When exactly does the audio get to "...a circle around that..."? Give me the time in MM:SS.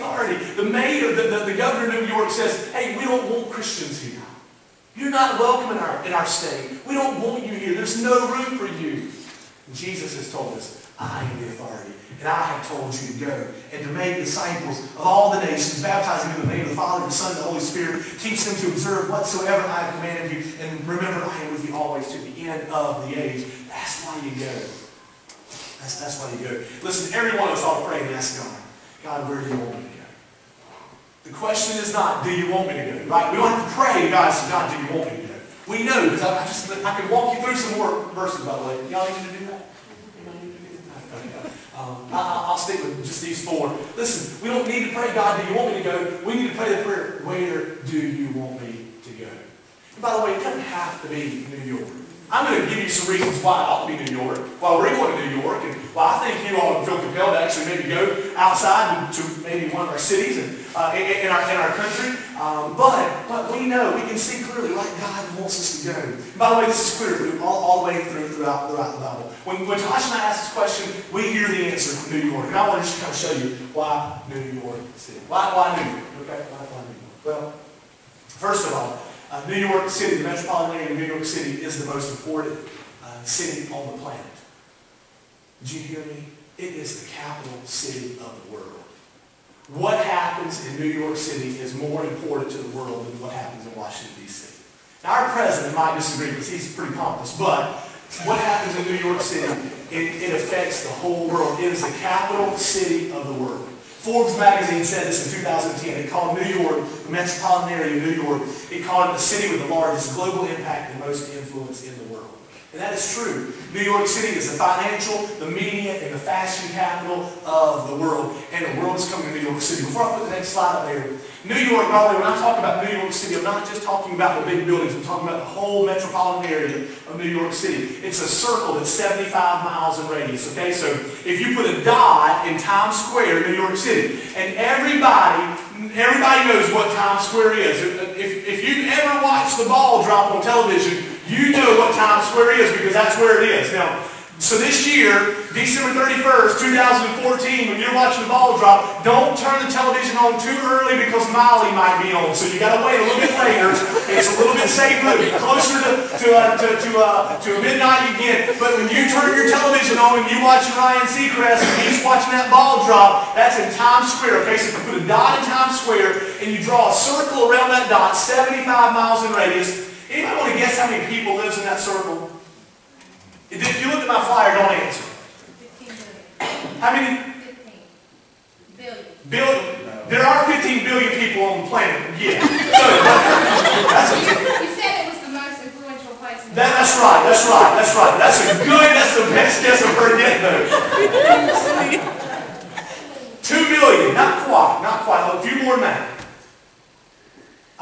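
02:46.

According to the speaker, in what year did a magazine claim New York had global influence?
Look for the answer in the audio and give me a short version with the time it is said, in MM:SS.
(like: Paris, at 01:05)
2010, at 01:45.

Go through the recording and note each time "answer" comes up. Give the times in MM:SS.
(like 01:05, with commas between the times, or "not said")
01:11, 02:54.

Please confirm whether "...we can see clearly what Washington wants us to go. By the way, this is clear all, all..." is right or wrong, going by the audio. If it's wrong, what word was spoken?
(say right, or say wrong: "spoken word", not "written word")
wrong: "God", not "Washington".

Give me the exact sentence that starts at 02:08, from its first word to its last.
It's a circle that's 75 miles in radius, okay?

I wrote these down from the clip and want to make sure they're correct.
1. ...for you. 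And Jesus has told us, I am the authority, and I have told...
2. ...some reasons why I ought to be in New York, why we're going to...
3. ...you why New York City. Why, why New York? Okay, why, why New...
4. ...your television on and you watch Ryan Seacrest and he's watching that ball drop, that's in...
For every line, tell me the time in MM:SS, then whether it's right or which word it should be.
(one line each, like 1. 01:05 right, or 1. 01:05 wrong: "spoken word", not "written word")
1. 00:08 right
2. 00:52 right
3. 01:13 right
4. 02:39 right.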